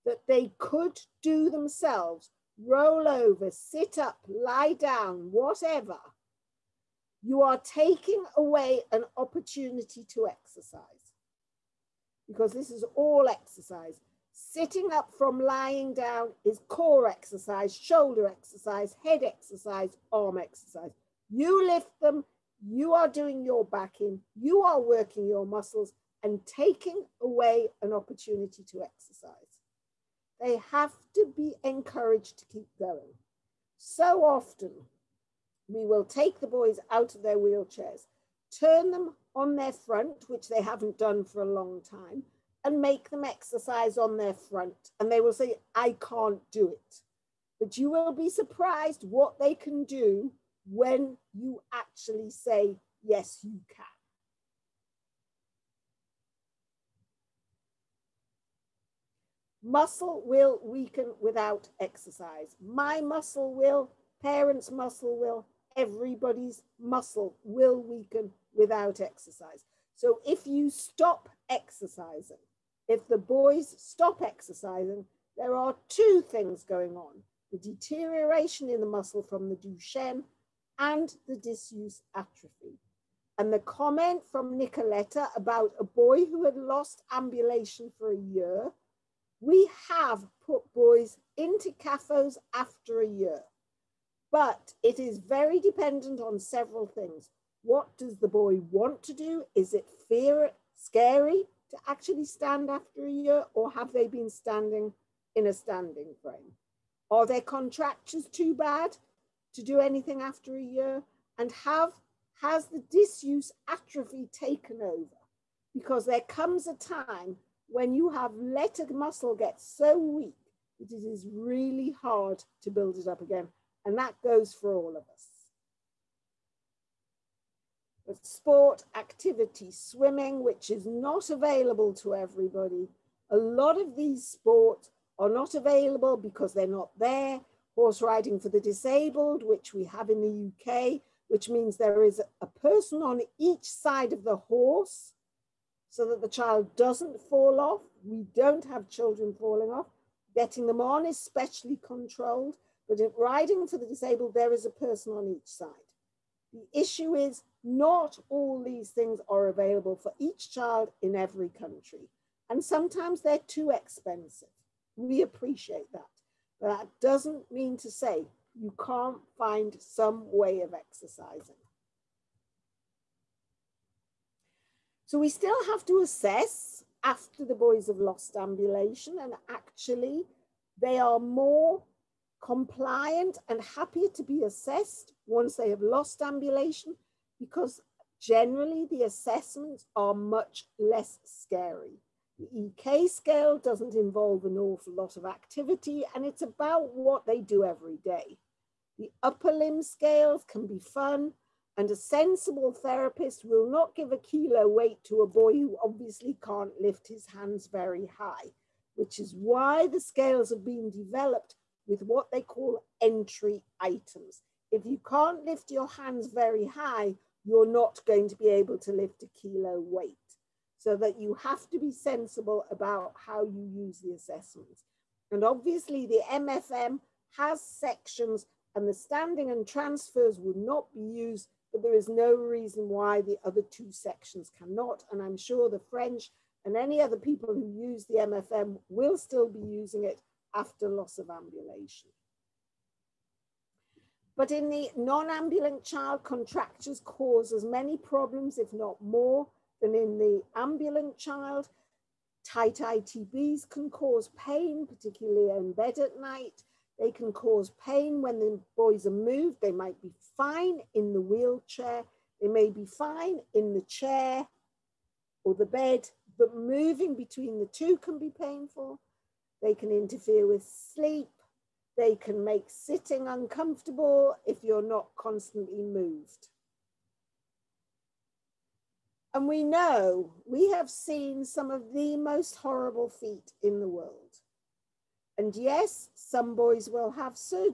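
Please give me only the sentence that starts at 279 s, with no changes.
And we know we have seen some of the most horrible feet in the world.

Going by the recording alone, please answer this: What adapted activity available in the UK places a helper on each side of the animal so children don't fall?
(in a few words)
Horse riding for the disabled.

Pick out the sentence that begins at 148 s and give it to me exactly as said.
We don't have children falling off.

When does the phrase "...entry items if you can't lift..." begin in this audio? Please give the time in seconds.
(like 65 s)
213 s.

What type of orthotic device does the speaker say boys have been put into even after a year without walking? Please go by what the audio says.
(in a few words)
CAFOs.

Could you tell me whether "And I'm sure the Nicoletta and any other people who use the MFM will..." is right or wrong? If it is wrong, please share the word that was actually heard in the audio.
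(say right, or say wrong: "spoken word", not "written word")
wrong: "French", not "Nicoletta".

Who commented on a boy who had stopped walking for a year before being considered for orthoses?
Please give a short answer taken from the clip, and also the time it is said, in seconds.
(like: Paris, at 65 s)
Nicoletta, at 84 s.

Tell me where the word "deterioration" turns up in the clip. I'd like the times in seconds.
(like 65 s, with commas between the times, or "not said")
77 s.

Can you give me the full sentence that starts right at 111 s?
And have has the disuse atrophy taken over?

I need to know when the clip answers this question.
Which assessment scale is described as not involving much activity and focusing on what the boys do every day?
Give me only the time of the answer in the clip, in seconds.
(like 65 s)
192 s.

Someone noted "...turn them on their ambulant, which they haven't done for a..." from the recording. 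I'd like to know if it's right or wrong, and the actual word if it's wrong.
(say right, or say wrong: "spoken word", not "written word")
wrong: "front", not "ambulant".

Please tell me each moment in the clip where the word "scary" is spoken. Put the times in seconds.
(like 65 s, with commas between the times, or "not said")
100 s, 191 s.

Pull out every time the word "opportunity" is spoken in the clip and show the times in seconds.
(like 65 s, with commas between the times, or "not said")
9 s, 27 s.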